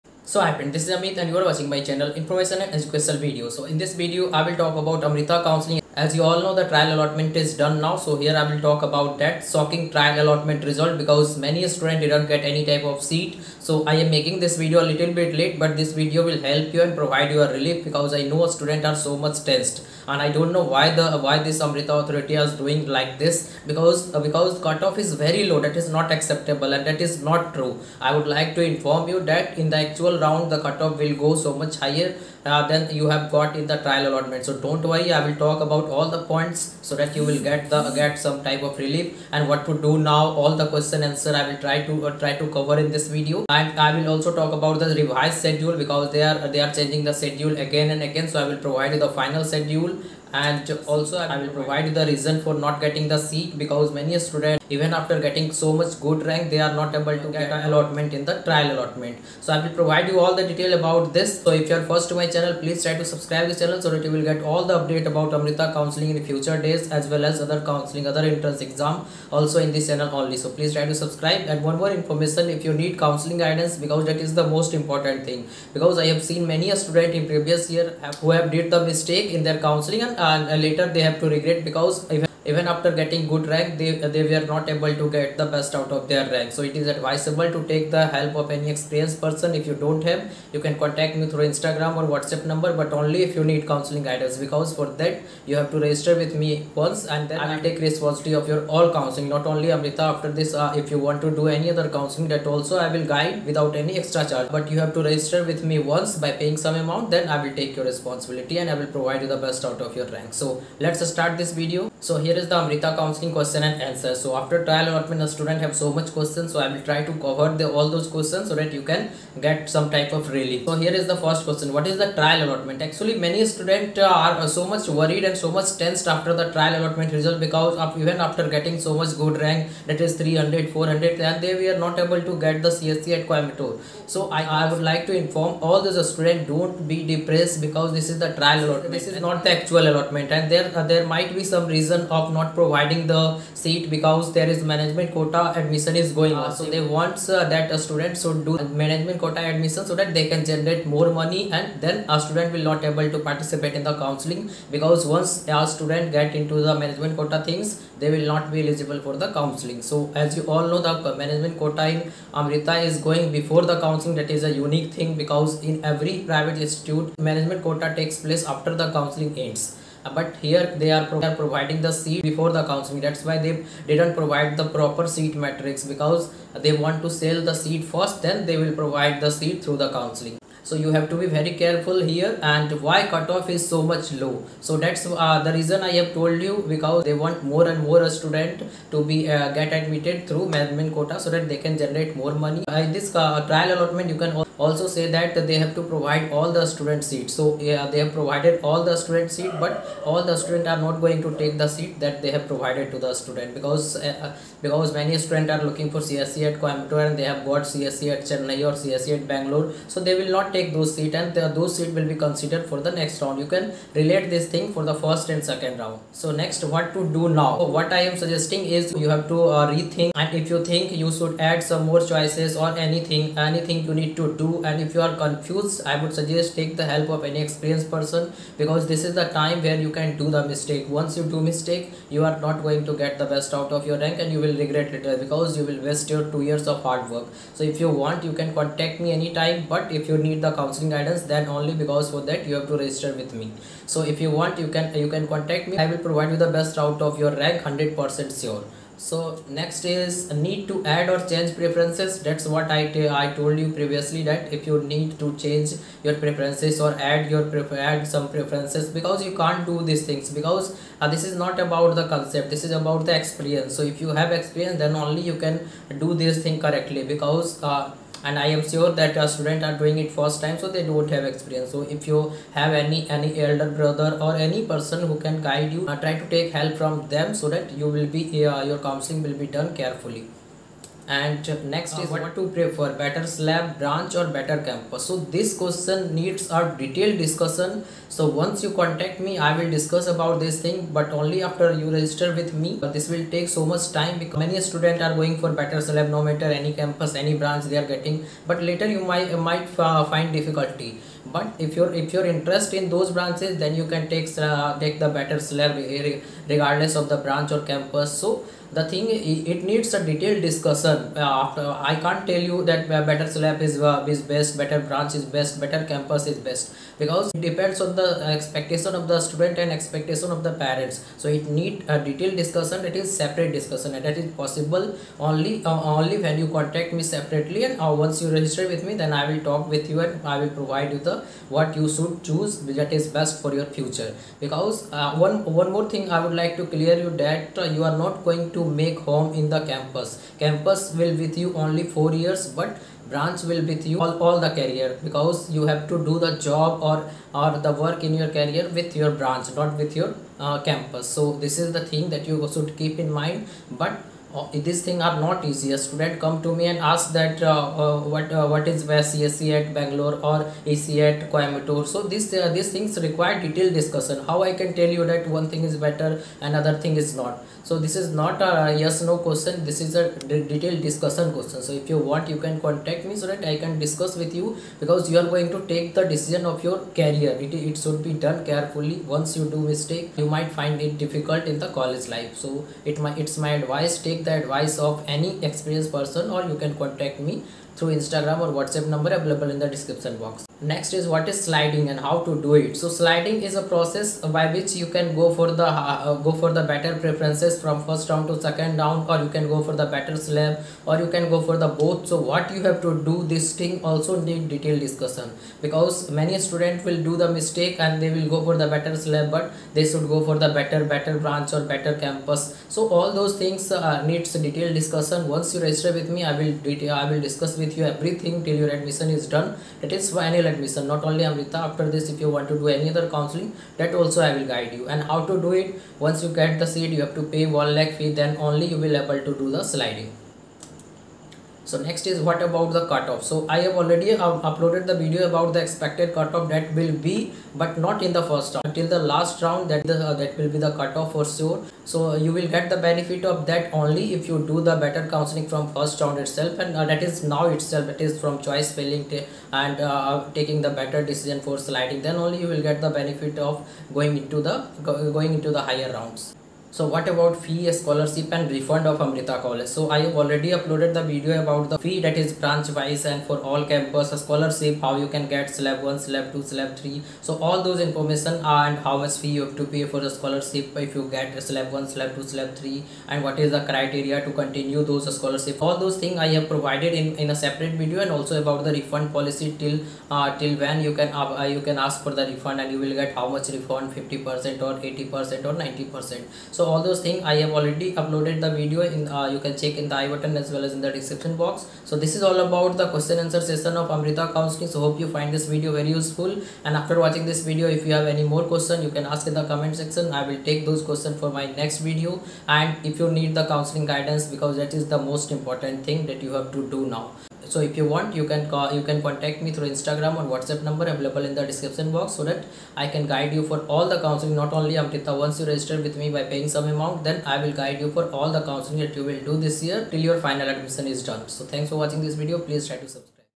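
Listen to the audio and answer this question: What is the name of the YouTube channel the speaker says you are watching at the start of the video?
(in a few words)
Information and Educational Video.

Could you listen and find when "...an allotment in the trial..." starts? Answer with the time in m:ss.
0:57.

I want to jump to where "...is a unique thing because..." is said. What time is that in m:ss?
2:44.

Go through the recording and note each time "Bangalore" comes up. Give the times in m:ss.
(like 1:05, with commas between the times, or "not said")
3:29, 5:59.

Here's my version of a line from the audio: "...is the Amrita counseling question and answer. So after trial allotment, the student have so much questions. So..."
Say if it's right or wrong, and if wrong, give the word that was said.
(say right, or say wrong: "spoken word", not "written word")
right.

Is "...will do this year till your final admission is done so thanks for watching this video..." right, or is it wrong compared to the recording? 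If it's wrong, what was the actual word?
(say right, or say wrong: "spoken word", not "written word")
right.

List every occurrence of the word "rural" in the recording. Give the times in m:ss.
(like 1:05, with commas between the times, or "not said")
not said.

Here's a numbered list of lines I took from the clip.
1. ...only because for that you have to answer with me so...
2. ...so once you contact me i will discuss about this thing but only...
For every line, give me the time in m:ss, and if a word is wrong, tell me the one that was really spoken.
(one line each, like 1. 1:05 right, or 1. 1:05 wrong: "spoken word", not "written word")
1. 4:01 wrong: "register", not "answer"
2. 4:48 right.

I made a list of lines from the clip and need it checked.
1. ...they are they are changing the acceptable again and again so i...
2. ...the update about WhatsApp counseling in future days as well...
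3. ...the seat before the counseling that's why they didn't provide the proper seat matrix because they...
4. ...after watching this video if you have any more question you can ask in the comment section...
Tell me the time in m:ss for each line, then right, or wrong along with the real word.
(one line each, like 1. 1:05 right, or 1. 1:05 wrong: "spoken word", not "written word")
1. 0:46 wrong: "schedule", not "acceptable"
2. 1:04 wrong: "Amrita", not "WhatsApp"
3. 2:51 right
4. 8:16 right.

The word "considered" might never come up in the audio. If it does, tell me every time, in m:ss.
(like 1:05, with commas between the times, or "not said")
3:32.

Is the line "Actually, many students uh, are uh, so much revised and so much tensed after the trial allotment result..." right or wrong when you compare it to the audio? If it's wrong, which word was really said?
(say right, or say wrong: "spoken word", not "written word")
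wrong: "worried", not "revised".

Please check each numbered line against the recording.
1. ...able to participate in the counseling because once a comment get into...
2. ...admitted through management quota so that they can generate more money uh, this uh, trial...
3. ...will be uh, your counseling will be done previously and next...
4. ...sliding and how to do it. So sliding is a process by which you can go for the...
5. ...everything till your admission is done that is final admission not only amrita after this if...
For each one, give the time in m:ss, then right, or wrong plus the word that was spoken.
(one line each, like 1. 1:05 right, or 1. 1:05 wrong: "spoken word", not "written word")
1. 2:32 wrong: "student", not "comment"
2. 3:09 right
3. 4:37 wrong: "carefully", not "previously"
4. 6:31 right
5. 6:57 right.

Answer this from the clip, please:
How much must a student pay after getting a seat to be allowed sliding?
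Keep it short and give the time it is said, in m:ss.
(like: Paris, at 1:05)
1 lakh, at 7:07.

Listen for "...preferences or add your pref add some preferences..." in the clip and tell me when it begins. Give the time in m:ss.
4:16.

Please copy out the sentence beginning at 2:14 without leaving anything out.
So I, I would like to inform all those students don't be depressed because this is the trial allotment.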